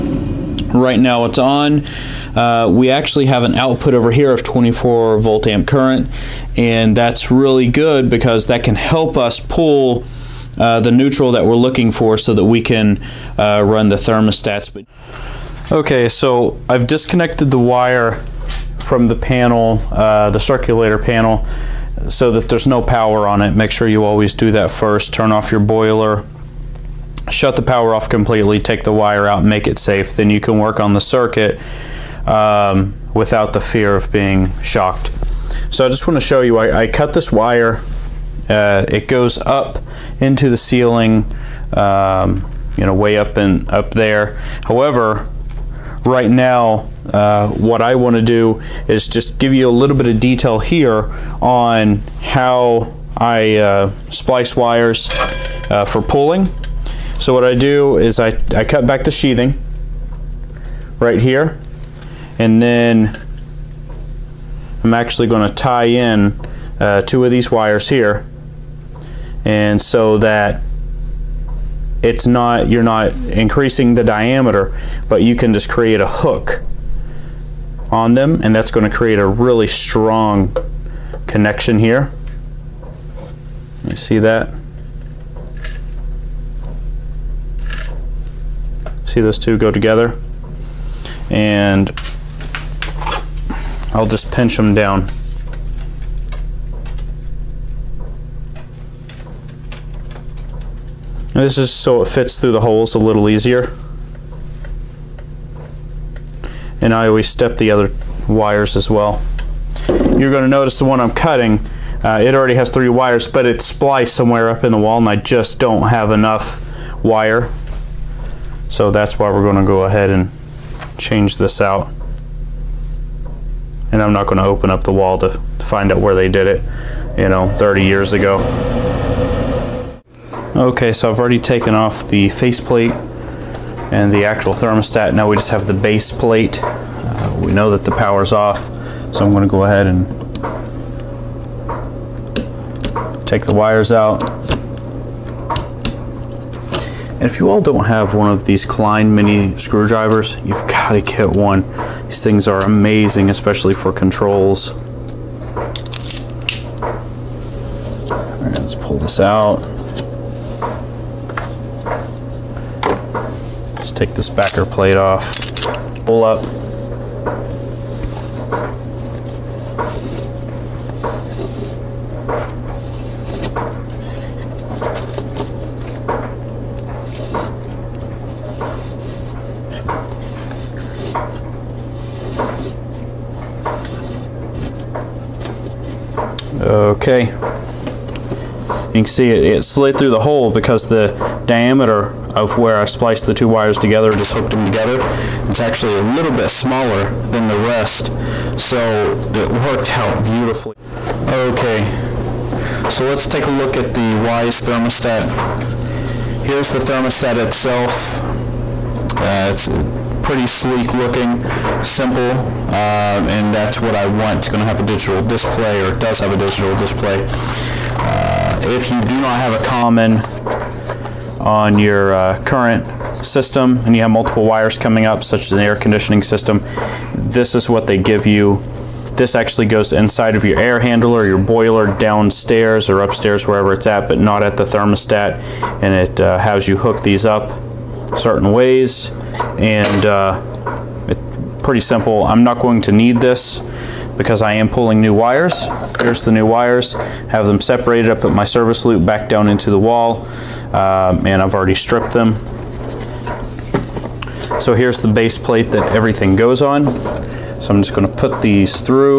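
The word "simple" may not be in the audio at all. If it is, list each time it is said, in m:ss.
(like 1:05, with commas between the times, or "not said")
3:31, 4:01.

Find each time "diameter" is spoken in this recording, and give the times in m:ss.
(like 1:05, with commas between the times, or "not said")
1:14, 3:11.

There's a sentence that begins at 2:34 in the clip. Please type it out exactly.
All right, let's pull this out.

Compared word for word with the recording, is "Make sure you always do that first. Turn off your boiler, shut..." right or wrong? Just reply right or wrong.
right.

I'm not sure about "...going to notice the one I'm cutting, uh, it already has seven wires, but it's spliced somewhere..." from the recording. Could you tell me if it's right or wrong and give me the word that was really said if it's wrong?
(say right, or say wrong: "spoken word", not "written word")
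wrong: "three", not "seven".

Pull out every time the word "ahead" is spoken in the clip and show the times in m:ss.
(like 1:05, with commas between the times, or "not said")
1:59, 2:19.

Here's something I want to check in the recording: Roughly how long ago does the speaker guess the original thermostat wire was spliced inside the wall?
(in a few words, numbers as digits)
30 years ago.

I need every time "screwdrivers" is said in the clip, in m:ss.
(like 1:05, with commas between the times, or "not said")
2:29.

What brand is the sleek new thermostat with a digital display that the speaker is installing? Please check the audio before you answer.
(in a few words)
Wyze.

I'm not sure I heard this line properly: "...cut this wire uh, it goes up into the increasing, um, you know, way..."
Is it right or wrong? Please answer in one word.
wrong.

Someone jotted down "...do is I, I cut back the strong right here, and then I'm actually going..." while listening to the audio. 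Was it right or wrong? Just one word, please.
wrong.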